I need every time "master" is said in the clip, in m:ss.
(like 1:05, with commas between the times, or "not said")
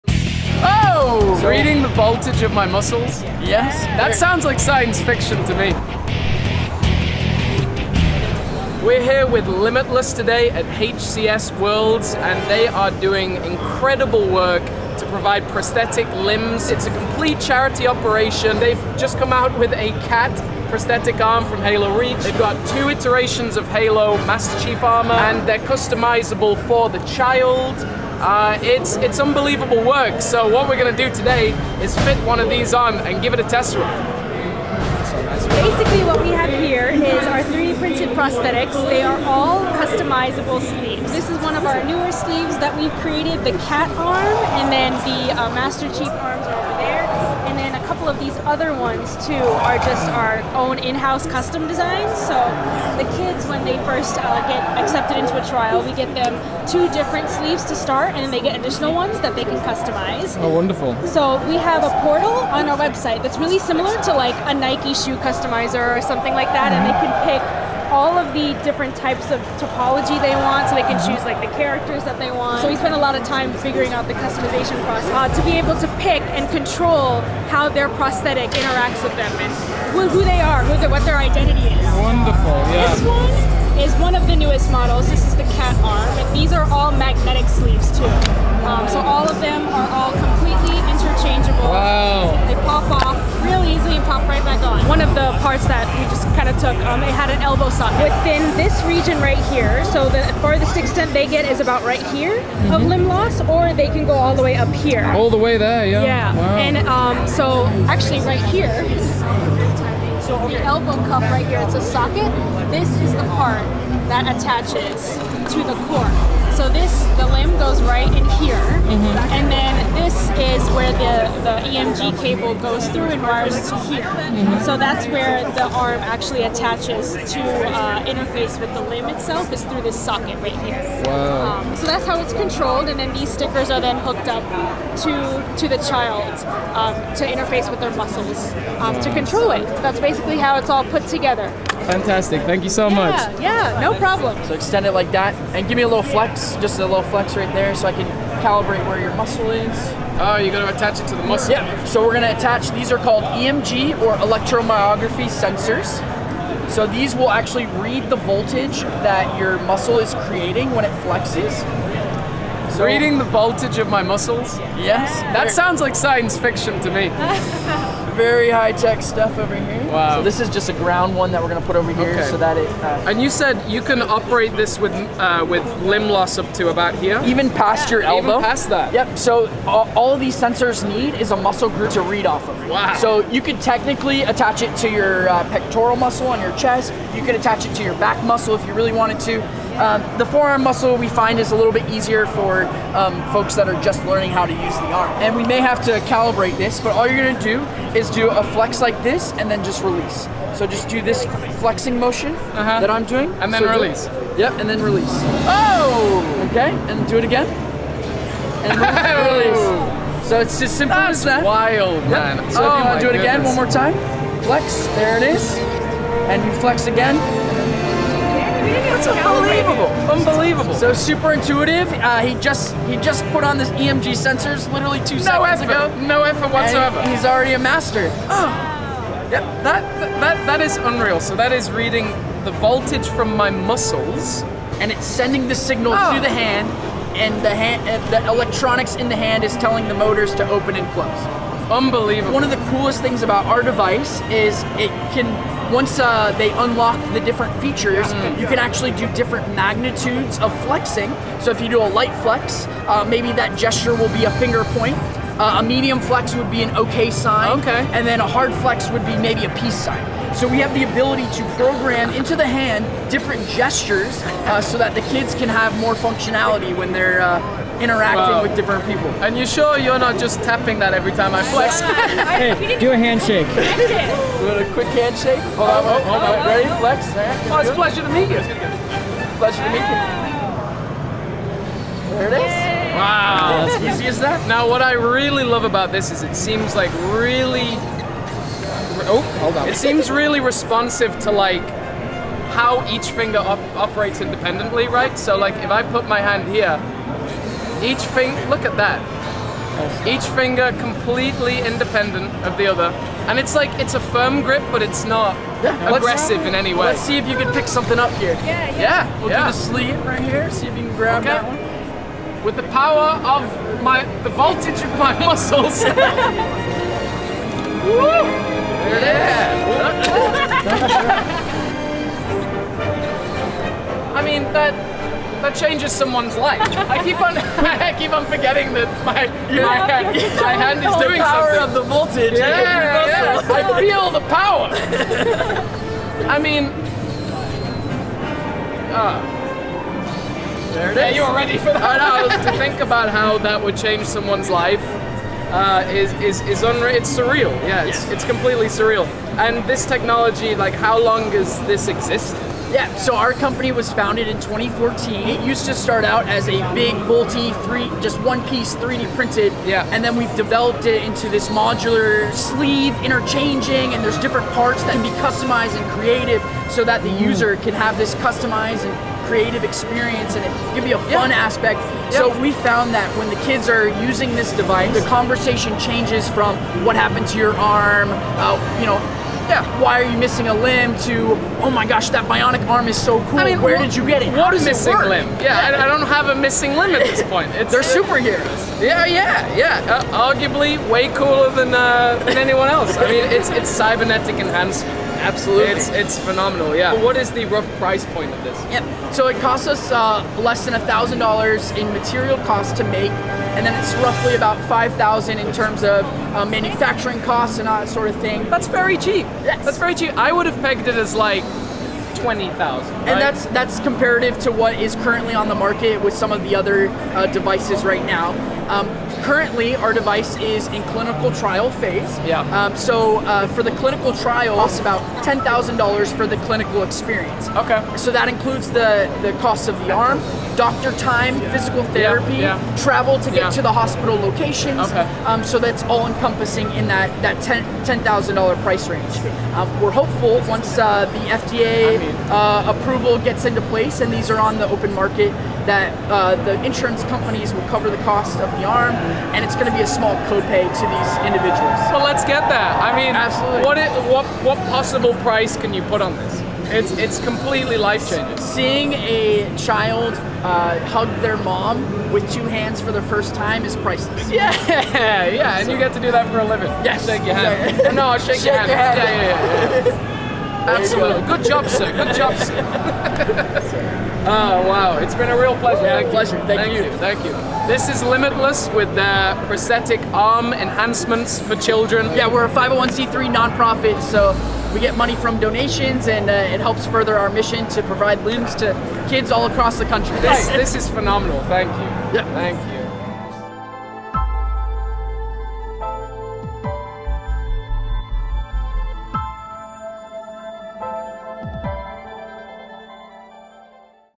0:24, 0:45, 3:47.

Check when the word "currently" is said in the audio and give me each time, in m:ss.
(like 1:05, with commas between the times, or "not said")
6:54, 6:59.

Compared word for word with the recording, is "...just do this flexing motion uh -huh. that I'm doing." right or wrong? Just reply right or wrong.
right.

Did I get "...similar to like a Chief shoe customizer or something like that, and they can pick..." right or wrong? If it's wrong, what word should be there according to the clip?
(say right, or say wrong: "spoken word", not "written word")
wrong: "Nike", not "Chief".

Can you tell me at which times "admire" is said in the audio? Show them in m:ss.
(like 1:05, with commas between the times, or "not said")
not said.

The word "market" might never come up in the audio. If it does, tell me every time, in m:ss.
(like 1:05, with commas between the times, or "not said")
6:55, 7:24.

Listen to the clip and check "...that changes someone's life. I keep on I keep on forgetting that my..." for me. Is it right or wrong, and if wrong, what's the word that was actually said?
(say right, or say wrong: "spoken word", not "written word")
right.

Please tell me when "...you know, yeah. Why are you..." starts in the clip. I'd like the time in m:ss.
6:18.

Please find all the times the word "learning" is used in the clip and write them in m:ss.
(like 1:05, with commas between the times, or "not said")
3:14.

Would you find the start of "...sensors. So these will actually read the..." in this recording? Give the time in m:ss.
2:35.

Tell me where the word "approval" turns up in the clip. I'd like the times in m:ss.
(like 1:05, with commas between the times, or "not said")
7:22.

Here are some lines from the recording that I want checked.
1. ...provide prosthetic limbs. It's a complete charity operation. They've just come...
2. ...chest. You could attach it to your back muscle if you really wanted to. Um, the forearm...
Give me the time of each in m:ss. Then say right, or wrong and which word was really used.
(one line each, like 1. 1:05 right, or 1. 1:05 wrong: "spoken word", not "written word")
1. 0:15 right
2. 3:06 right.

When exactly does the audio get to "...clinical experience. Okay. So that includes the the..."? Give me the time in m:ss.
7:06.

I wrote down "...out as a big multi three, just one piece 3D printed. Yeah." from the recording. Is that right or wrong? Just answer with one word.
right.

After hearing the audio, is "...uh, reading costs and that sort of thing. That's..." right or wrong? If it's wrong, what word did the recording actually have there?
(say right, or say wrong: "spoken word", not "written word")
wrong: "manufacturing", not "reading".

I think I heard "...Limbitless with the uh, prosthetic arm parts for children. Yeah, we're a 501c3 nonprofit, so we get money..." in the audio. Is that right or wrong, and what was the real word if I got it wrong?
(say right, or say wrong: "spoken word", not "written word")
wrong: "enhancements", not "parts".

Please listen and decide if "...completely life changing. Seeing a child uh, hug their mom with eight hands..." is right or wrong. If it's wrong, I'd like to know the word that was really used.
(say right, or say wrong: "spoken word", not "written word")
wrong: "two", not "eight".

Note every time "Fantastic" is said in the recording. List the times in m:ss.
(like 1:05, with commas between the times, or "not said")
2:21.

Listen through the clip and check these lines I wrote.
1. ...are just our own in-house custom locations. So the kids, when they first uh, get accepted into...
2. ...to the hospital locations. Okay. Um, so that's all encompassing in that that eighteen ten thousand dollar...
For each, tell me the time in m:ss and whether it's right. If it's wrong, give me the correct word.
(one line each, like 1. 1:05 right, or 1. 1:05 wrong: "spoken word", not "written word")
1. 0:49 wrong: "designs", not "locations"
2. 7:13 wrong: "ten", not "eighteen".